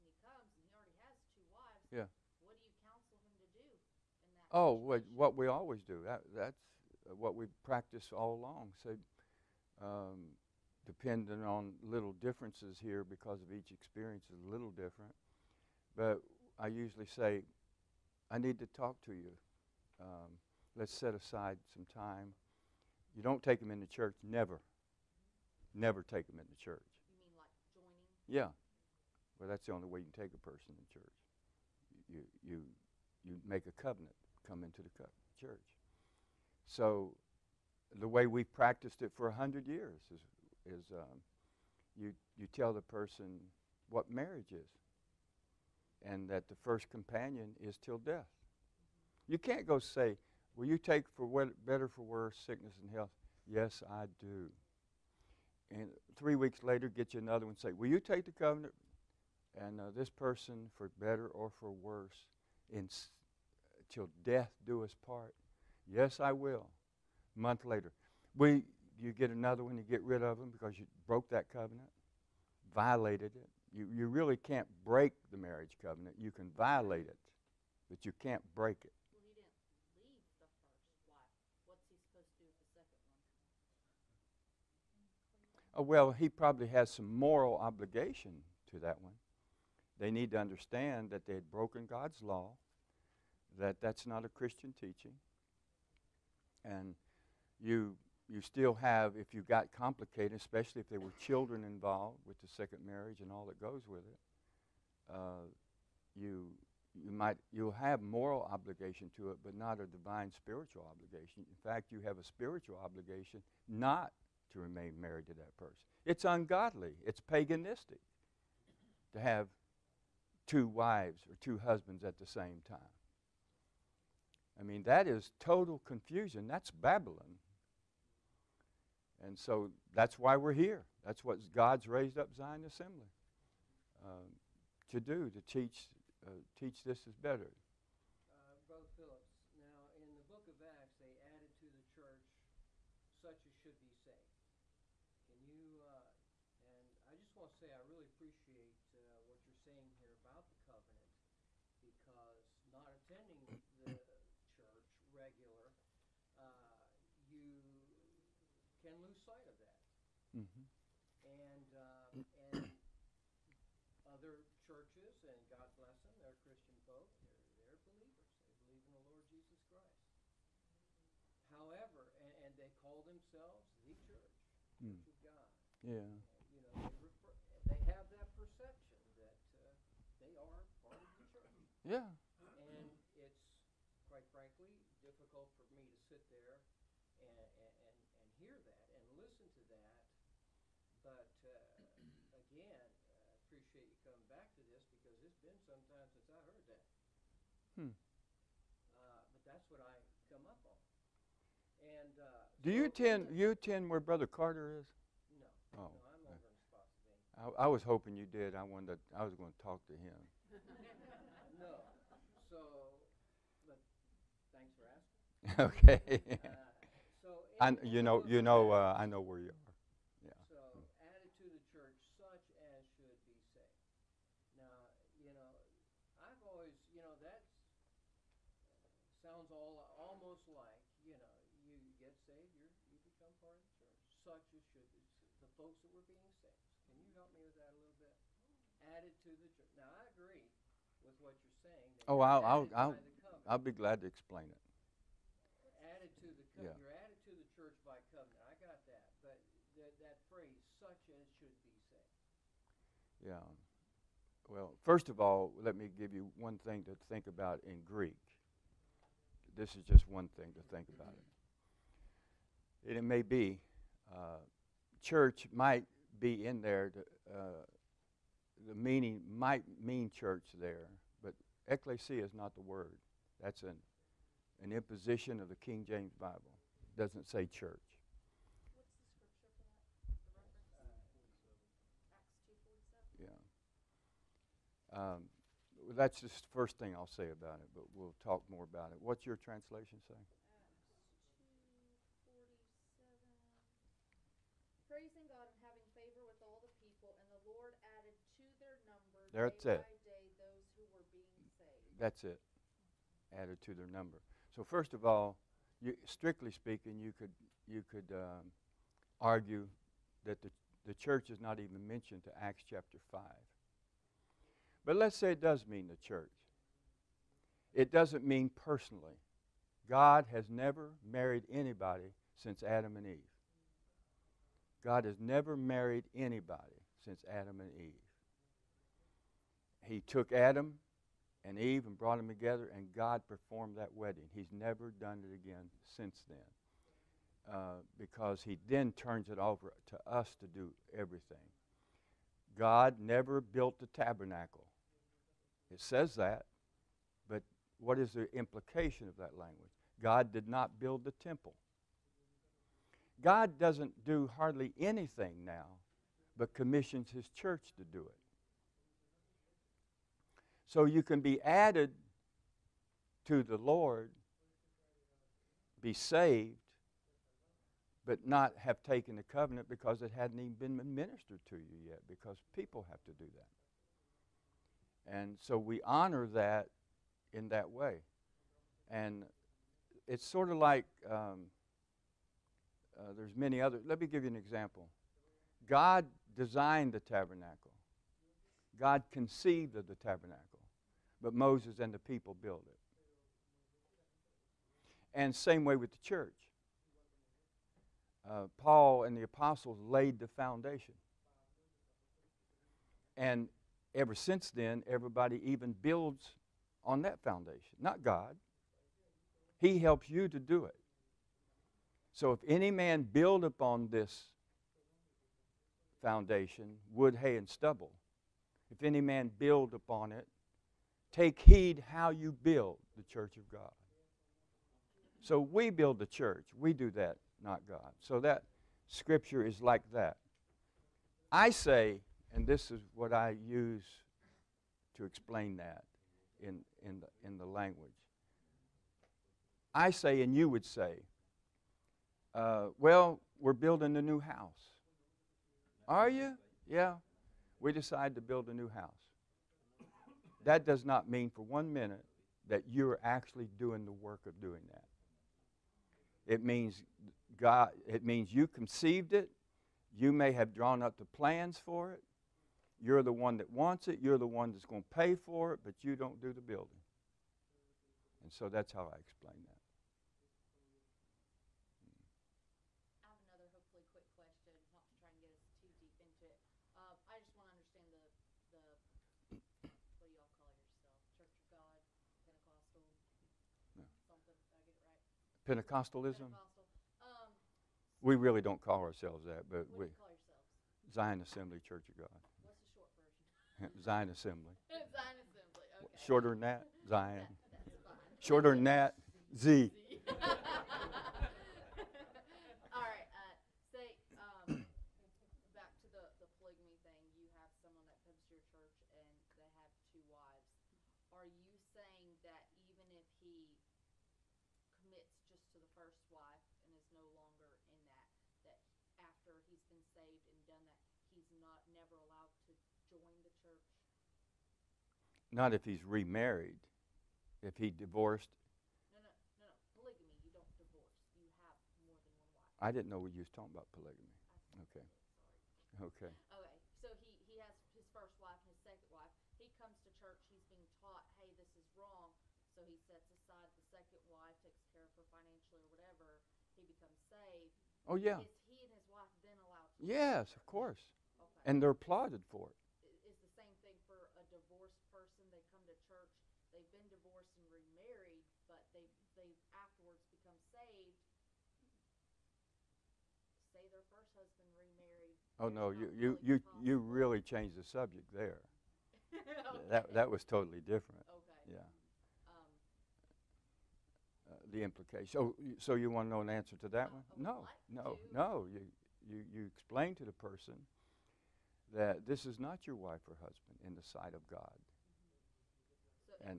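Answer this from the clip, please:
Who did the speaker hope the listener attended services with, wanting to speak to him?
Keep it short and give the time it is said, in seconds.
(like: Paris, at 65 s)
Brother Carter, at 203 s.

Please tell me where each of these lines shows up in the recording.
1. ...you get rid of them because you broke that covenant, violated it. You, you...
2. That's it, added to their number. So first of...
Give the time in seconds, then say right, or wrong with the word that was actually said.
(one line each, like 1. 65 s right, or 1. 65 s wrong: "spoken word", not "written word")
1. 69 s right
2. 301 s right.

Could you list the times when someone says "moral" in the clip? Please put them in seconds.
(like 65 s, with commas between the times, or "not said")
87 s, 108 s.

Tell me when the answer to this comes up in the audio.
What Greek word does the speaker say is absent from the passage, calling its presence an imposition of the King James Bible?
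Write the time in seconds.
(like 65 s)
271 s.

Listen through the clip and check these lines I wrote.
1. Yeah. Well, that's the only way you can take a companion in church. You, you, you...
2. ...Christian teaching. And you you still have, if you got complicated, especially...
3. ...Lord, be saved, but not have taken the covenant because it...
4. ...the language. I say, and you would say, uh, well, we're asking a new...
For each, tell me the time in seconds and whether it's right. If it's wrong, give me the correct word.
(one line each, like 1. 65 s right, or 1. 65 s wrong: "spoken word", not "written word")
1. 28 s wrong: "person", not "companion"
2. 94 s right
3. 363 s right
4. 437 s wrong: "building", not "asking".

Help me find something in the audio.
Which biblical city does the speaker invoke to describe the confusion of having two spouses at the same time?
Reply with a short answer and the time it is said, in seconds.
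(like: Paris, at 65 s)
Babylon, at 126 s.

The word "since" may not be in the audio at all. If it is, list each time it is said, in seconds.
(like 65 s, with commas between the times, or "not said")
322 s, 327 s, 335 s, 404 s.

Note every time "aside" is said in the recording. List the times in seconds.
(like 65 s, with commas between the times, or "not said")
21 s, 543 s.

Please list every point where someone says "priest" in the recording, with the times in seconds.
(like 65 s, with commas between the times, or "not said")
not said.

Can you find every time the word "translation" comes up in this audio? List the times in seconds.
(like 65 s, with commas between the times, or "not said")
289 s.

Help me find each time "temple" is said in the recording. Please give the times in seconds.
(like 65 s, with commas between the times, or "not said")
351 s.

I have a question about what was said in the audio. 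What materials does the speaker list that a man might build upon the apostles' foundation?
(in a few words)
wood, hay, and stubble.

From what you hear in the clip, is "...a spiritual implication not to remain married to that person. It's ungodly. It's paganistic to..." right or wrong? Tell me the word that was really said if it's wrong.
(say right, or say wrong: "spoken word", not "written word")
wrong: "obligation", not "implication".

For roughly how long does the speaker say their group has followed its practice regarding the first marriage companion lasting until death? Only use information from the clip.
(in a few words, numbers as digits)
100 years.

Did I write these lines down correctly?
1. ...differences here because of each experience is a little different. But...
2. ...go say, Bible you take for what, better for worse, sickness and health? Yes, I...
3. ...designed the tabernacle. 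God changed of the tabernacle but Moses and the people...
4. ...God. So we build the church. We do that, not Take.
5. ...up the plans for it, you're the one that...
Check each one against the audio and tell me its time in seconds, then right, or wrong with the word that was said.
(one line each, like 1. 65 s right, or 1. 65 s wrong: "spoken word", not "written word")
1. 12 s right
2. 49 s wrong: "Will", not "Bible"
3. 386 s wrong: "conceived", not "changed"
4. 423 s wrong: "God", not "Take"
5. 460 s right.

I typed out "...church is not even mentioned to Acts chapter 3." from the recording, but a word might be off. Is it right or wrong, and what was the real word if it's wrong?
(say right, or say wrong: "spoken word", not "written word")
wrong: "5", not "3".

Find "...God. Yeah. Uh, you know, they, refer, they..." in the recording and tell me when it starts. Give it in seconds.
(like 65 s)
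175 s.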